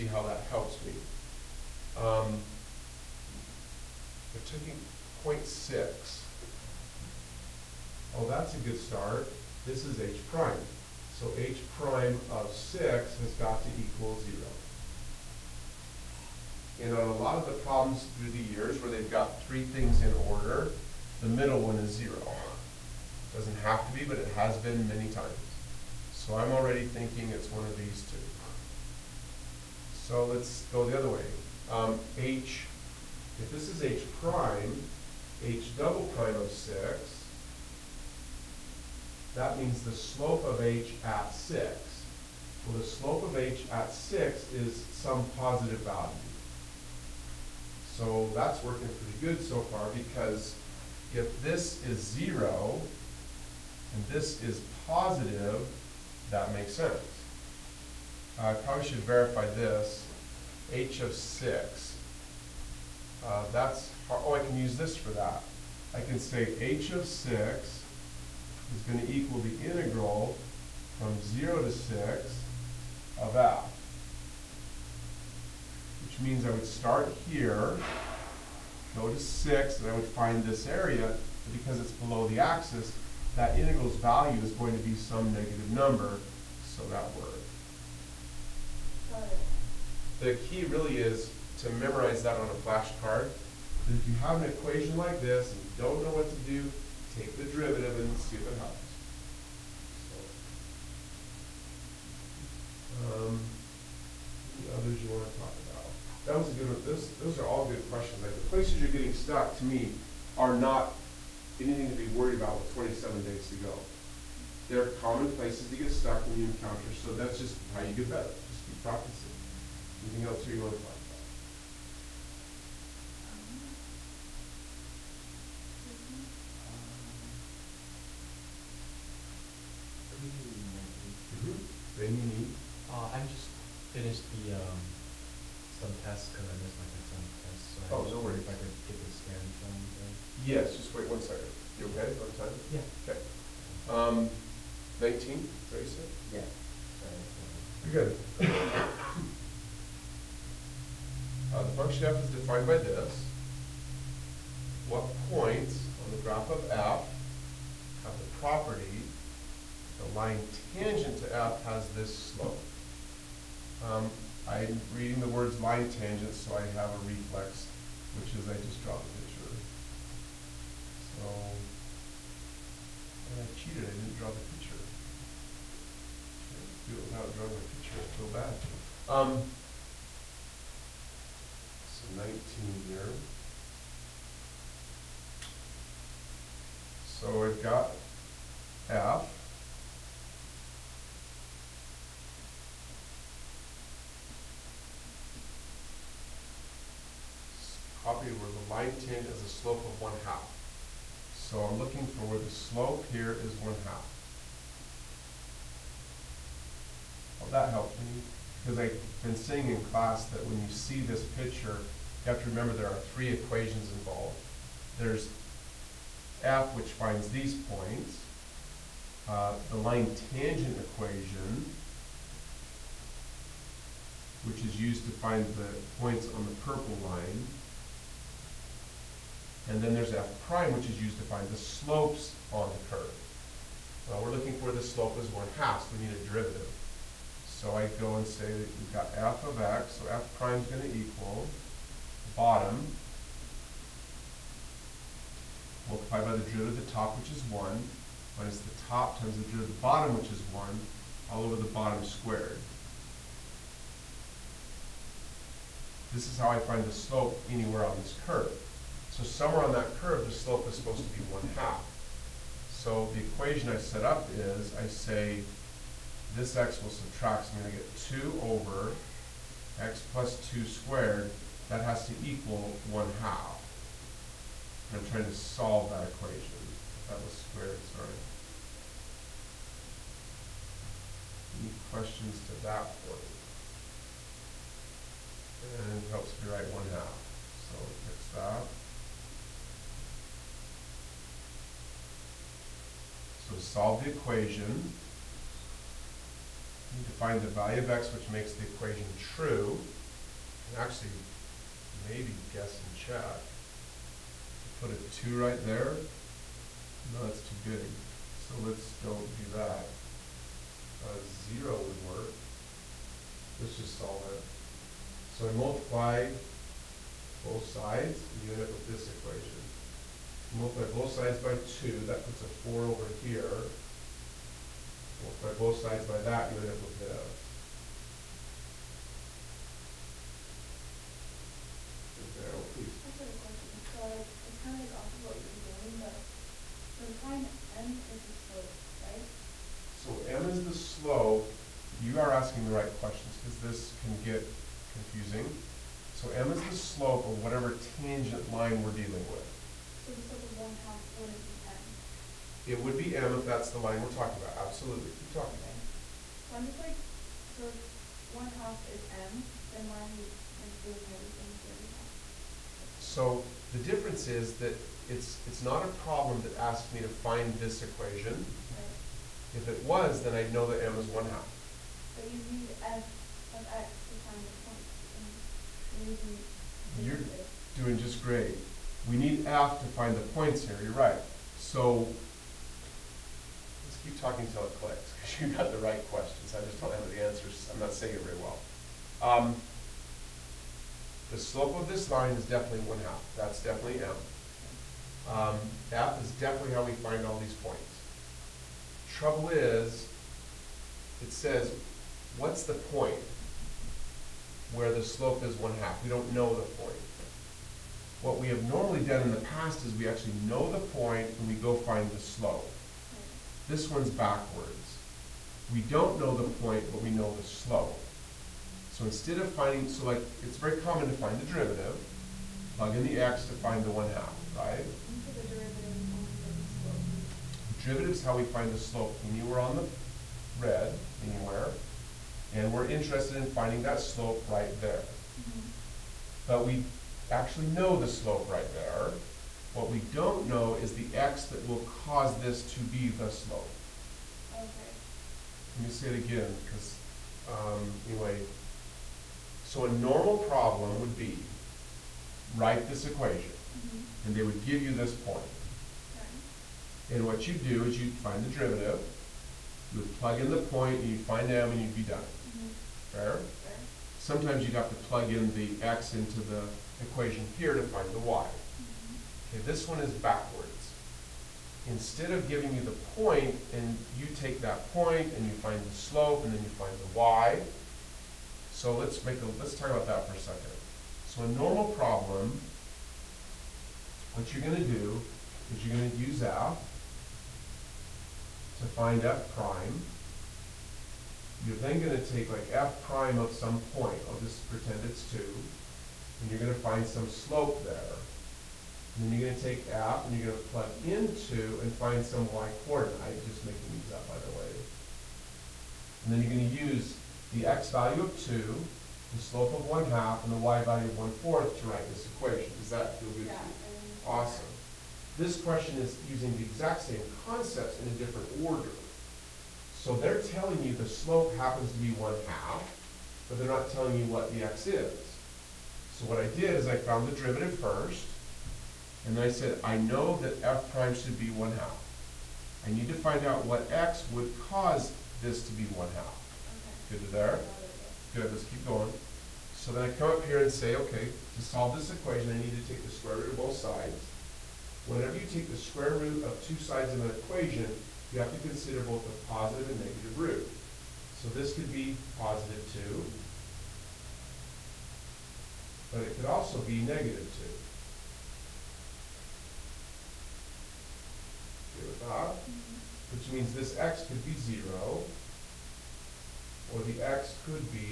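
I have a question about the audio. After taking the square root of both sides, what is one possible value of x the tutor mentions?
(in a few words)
0.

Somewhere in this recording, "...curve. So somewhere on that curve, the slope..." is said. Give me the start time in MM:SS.
04:18.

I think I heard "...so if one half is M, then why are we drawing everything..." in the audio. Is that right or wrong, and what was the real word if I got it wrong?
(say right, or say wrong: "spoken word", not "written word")
wrong: "including", not "drawing".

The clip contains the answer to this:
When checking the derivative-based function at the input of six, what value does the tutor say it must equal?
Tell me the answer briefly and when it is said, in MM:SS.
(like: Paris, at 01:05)
0, at 00:11.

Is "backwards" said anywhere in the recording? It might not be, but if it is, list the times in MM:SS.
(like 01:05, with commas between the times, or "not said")
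06:54, 07:50.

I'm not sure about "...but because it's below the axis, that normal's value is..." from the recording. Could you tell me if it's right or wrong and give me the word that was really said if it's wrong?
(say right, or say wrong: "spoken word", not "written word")
wrong: "integral", not "normal".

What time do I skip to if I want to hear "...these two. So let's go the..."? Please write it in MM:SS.
00:27.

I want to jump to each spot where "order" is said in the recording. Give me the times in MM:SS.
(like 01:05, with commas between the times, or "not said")
00:20, 08:38.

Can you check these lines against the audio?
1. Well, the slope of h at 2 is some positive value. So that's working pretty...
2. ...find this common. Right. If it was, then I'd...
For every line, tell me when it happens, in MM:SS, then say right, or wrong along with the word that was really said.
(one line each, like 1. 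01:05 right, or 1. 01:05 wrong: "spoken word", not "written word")
1. 00:42 wrong: "6", not "2"
2. 06:07 wrong: "equation", not "common".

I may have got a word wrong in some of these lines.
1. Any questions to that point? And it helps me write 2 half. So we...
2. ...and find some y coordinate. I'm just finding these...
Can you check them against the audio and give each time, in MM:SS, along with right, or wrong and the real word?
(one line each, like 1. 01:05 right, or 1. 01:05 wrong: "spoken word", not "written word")
1. 04:41 wrong: "1", not "2"
2. 08:21 wrong: "making", not "finding".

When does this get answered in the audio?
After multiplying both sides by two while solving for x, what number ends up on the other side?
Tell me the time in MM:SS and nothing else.
05:22.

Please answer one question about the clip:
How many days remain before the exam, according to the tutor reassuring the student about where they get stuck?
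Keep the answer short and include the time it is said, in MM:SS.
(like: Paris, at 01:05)
27, at 01:52.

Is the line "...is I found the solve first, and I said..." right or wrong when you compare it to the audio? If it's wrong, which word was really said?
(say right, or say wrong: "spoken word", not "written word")
wrong: "derivative", not "solve".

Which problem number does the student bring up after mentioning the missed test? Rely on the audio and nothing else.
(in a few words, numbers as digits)
19.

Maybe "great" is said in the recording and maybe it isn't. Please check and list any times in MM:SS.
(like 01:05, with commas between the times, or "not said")
06:18.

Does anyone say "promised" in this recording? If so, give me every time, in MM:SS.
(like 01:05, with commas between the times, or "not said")
not said.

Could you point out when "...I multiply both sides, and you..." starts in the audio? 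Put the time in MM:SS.
05:15.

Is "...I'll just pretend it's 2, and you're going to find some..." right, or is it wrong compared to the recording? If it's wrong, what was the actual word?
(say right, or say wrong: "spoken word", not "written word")
right.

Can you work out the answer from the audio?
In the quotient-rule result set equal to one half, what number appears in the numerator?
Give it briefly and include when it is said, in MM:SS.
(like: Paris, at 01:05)
2, at 04:28.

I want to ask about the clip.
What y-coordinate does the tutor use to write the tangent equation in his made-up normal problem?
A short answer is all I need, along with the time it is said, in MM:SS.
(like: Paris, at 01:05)
1/4, at 08:31.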